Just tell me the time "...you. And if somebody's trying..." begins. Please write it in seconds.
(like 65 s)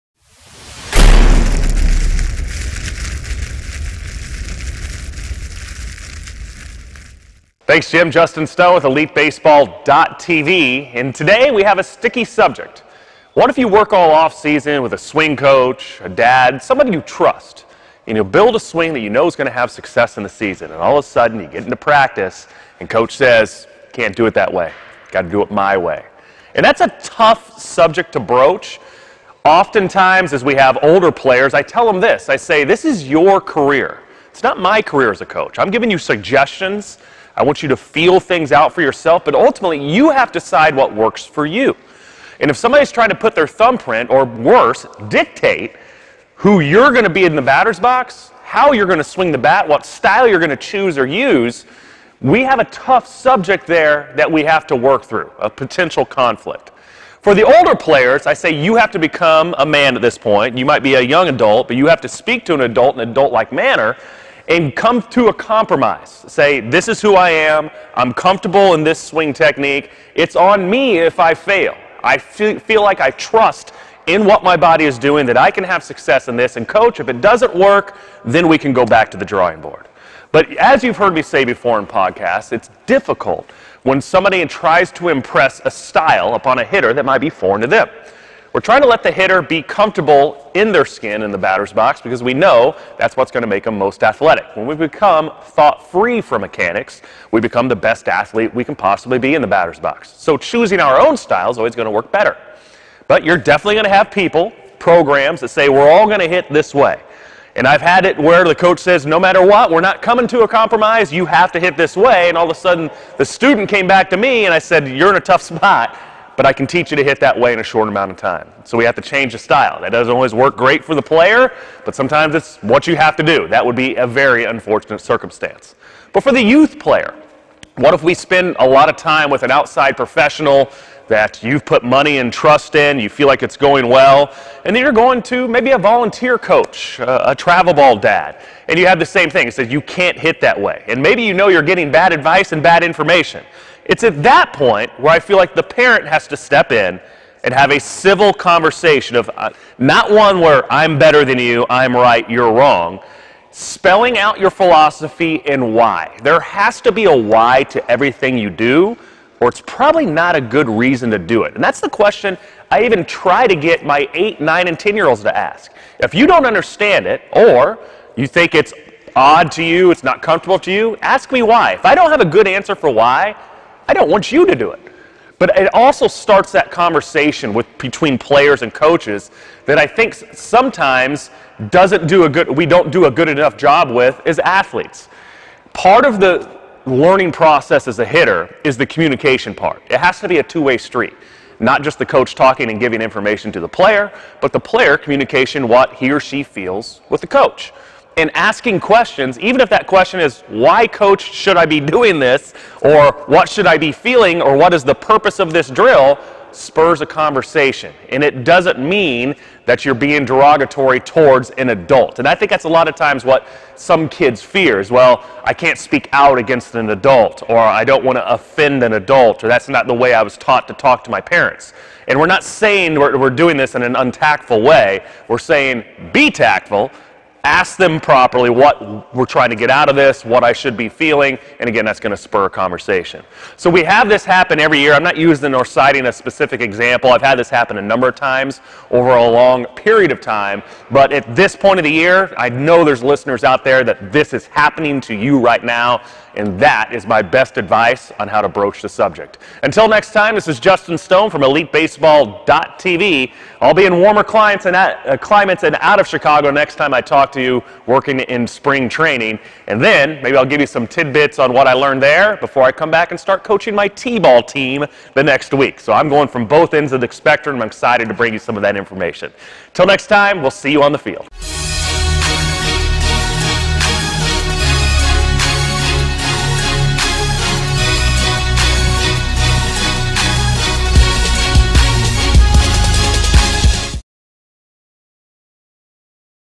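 41 s.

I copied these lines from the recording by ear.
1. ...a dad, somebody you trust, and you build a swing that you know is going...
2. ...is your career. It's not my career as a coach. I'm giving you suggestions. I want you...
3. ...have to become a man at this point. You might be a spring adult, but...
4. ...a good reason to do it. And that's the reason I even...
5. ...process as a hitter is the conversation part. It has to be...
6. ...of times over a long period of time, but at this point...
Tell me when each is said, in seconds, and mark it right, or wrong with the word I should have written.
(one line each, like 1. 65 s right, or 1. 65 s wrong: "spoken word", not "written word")
1. 16 s right
2. 32 s right
3. 58 s wrong: "young", not "spring"
4. 160 s wrong: "question", not "reason"
5. 187 s wrong: "communication", not "conversation"
6. 238 s right.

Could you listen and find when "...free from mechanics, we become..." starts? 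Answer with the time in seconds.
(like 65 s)
95 s.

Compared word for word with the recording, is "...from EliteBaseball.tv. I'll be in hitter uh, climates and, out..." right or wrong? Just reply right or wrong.
wrong.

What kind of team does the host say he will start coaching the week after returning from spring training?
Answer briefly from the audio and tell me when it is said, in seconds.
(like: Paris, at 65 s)
T-ball team, at 263 s.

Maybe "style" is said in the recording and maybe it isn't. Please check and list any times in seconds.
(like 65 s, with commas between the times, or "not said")
49 s, 85 s, 101 s, 119 s.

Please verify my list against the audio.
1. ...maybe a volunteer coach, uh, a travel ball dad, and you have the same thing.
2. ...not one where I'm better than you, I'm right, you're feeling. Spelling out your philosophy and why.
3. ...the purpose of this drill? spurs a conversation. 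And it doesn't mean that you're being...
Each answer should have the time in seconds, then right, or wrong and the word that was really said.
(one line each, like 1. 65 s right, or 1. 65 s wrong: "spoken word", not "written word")
1. 135 s right
2. 149 s wrong: "wrong", not "feeling"
3. 204 s right.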